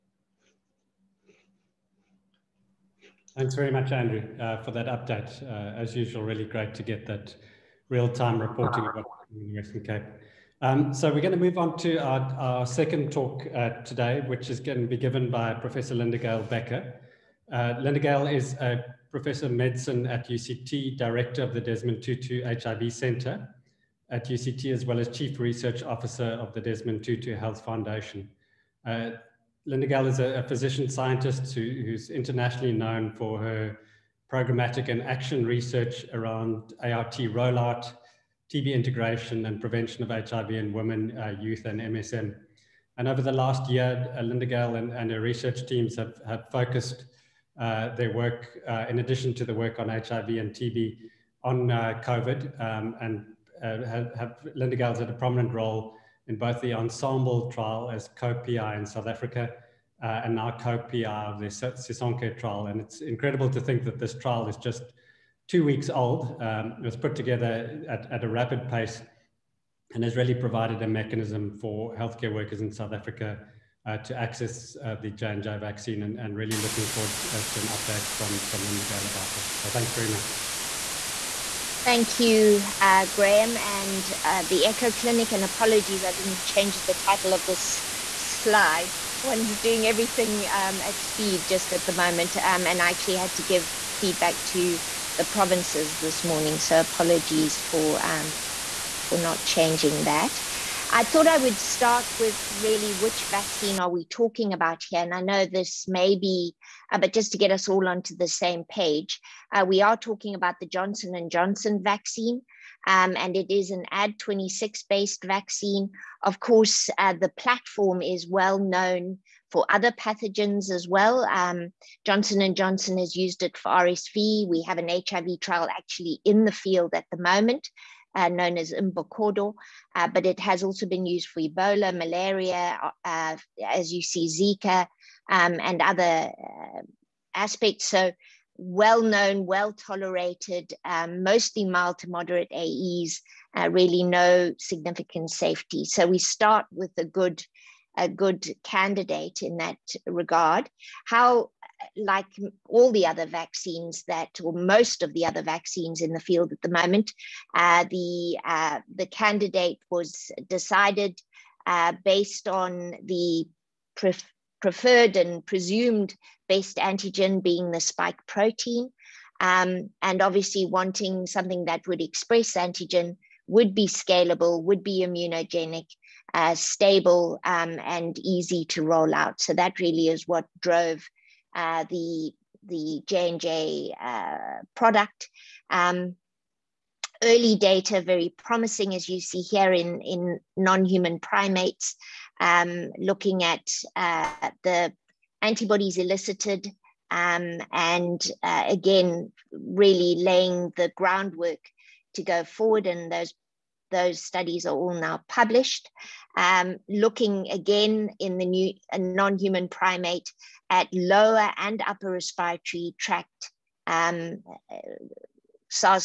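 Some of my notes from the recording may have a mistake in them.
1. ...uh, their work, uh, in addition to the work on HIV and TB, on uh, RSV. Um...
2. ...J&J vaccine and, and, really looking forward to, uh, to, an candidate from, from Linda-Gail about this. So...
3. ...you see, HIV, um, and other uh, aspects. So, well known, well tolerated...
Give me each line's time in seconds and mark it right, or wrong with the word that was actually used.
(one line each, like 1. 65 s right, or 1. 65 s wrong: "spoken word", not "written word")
1. 47 s wrong: "COVID", not "RSV"
2. 75 s wrong: "update", not "candidate"
3. 133 s wrong: "Zika", not "HIV".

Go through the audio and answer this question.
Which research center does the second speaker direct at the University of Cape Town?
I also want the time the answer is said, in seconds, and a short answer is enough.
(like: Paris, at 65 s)
Desmond Tutu HIV Center, at 21 s.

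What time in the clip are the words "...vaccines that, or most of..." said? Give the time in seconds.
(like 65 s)
153 s.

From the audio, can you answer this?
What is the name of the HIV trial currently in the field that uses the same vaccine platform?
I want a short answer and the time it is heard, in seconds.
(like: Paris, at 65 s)
Imbokodo, at 128 s.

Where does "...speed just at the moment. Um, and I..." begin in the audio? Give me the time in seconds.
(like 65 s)
91 s.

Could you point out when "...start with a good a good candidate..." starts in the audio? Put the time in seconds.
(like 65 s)
146 s.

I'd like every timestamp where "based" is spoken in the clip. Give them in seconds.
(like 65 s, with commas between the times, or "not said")
114 s, 162 s.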